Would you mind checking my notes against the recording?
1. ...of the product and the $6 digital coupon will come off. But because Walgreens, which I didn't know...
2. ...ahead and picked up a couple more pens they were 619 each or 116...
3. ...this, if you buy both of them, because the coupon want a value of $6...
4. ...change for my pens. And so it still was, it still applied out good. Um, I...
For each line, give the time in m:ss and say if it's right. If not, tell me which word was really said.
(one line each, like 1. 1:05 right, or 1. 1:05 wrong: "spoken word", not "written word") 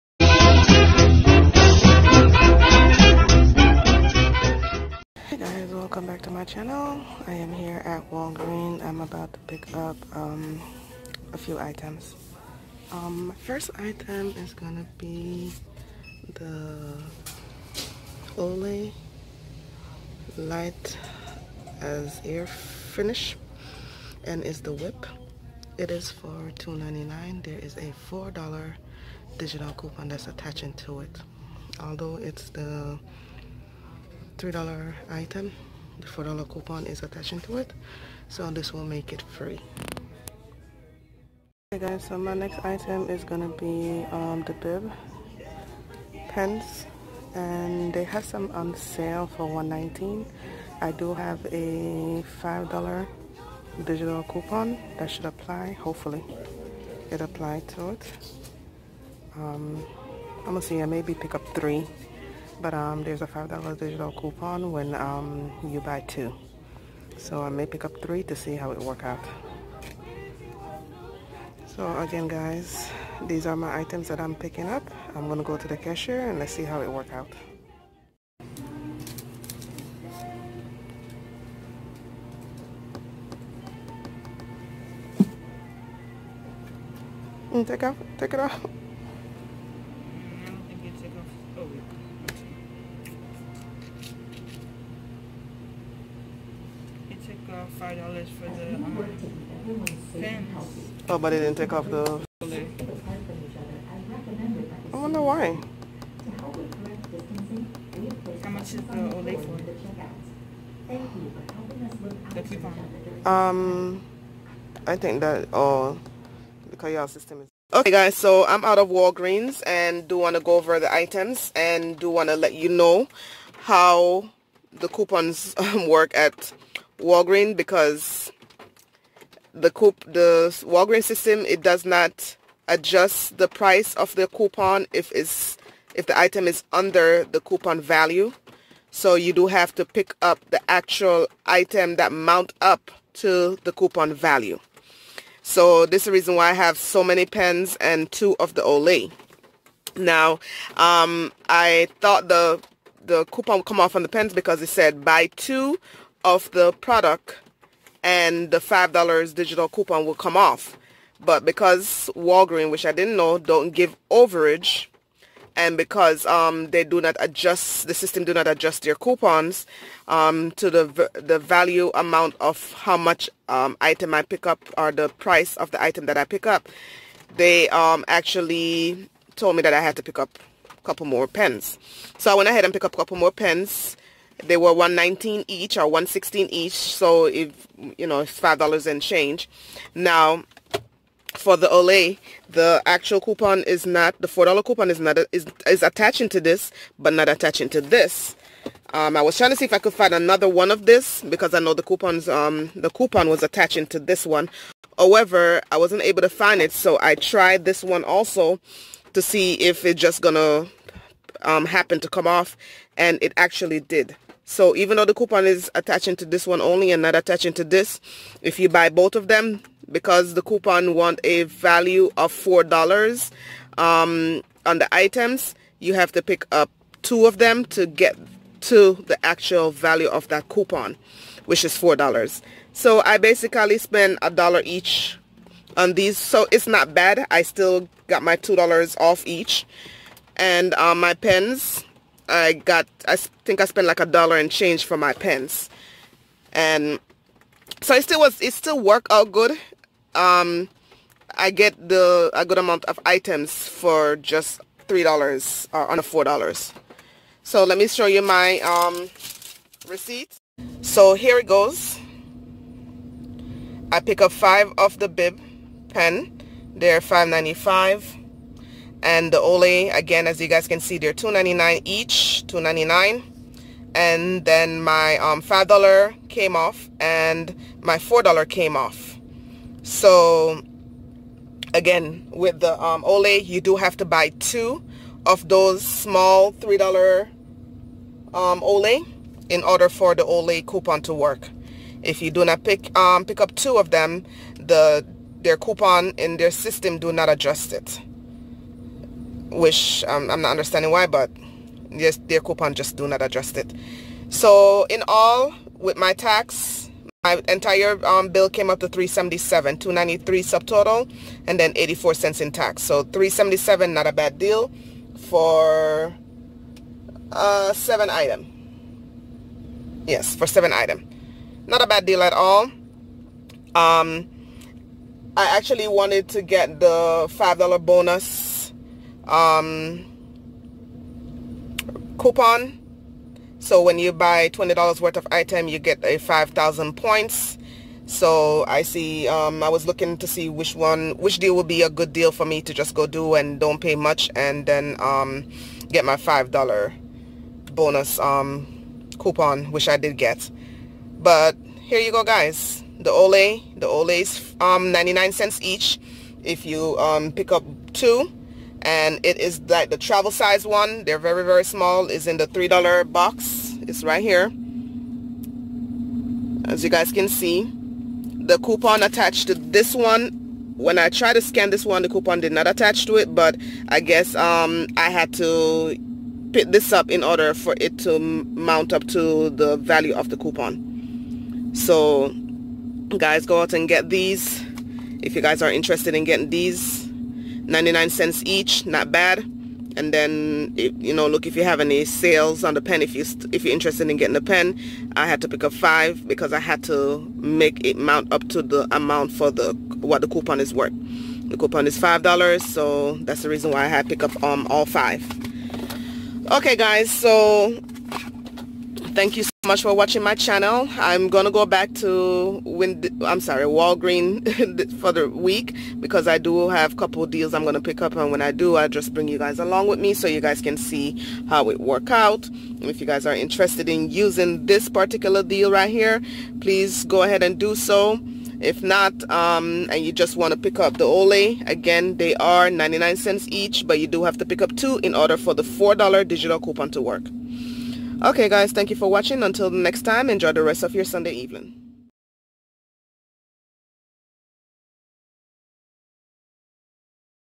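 1. 2:36 wrong: "5", not "6"
2. 3:02 wrong: "119", not "619"
3. 3:37 wrong: "4", not "6"
4. 4:04 wrong: "worked", not "applied".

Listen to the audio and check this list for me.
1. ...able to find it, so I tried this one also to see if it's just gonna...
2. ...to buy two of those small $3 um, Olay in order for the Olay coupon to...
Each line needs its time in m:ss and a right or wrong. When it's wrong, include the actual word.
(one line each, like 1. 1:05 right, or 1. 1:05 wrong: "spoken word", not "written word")
1. 3:26 right
2. 4:43 right.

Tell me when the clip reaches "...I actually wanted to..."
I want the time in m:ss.
5:25.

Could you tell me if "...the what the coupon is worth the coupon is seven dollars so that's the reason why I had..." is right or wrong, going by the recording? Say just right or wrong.
wrong.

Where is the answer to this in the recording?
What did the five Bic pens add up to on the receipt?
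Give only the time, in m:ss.
4:27.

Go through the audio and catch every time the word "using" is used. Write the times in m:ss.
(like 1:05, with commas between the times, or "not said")
7:04.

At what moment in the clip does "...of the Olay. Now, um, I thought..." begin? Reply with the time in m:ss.
2:28.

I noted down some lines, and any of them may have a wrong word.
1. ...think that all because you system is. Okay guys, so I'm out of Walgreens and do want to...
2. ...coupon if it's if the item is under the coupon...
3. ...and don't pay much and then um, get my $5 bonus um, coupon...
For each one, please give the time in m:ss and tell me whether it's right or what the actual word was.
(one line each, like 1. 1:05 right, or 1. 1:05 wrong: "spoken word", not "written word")
1. 1:54 right
2. 2:14 right
3. 5:43 right.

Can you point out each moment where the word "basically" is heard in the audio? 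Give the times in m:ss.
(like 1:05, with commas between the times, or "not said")
3:53.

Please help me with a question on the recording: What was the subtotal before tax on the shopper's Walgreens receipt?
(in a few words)
$2.93.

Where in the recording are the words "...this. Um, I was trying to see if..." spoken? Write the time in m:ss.
3:17.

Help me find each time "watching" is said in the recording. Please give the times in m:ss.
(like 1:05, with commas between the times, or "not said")
6:49, 7:19.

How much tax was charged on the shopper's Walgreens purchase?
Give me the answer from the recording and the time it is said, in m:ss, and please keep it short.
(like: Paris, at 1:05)
84 cents, at 5:11.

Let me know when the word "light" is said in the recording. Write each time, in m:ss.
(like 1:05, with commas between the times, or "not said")
0:20.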